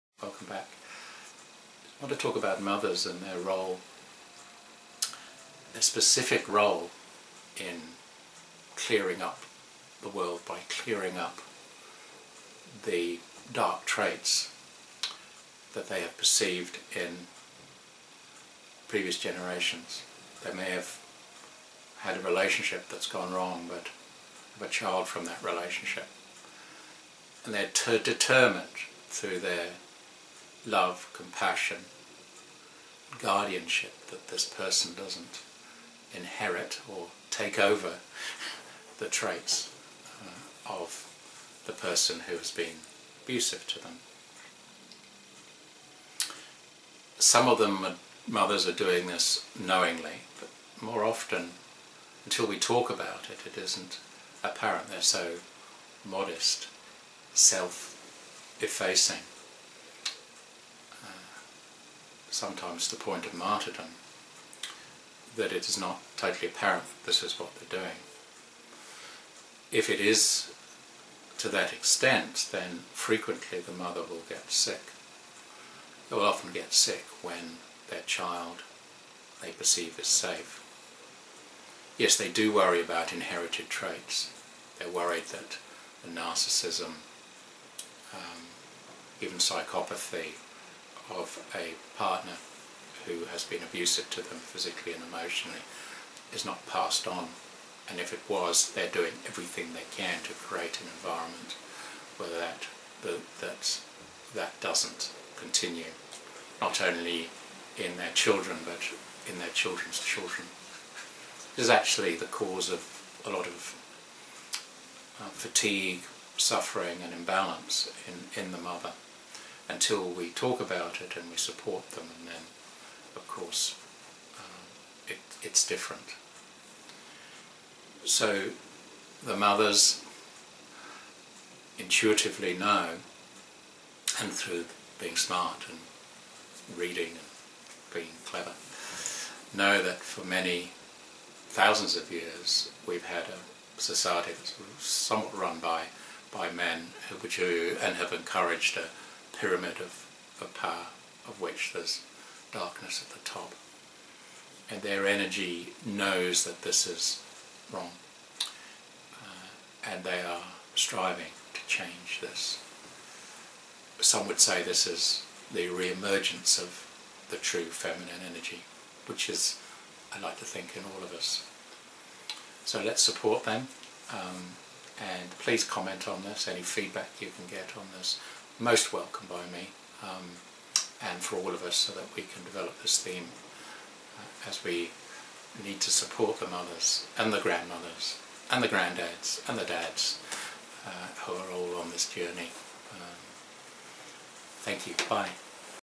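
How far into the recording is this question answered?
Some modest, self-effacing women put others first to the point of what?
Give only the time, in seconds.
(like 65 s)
63 s.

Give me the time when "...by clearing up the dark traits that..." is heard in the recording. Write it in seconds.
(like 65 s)
10 s.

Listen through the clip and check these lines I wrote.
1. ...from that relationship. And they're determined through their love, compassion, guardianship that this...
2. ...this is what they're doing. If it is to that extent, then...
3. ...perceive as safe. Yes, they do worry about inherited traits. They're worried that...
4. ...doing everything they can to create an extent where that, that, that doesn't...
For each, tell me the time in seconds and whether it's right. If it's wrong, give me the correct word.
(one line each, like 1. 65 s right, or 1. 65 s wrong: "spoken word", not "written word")
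1. 25 s right
2. 67 s right
3. 79 s right
4. 98 s wrong: "environment", not "extent".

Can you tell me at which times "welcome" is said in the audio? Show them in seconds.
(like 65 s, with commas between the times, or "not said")
0 s, 178 s.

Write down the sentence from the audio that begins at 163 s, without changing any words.
Some would say this is the re-emergence of the true feminine energy, which is, I like to think, in all of us.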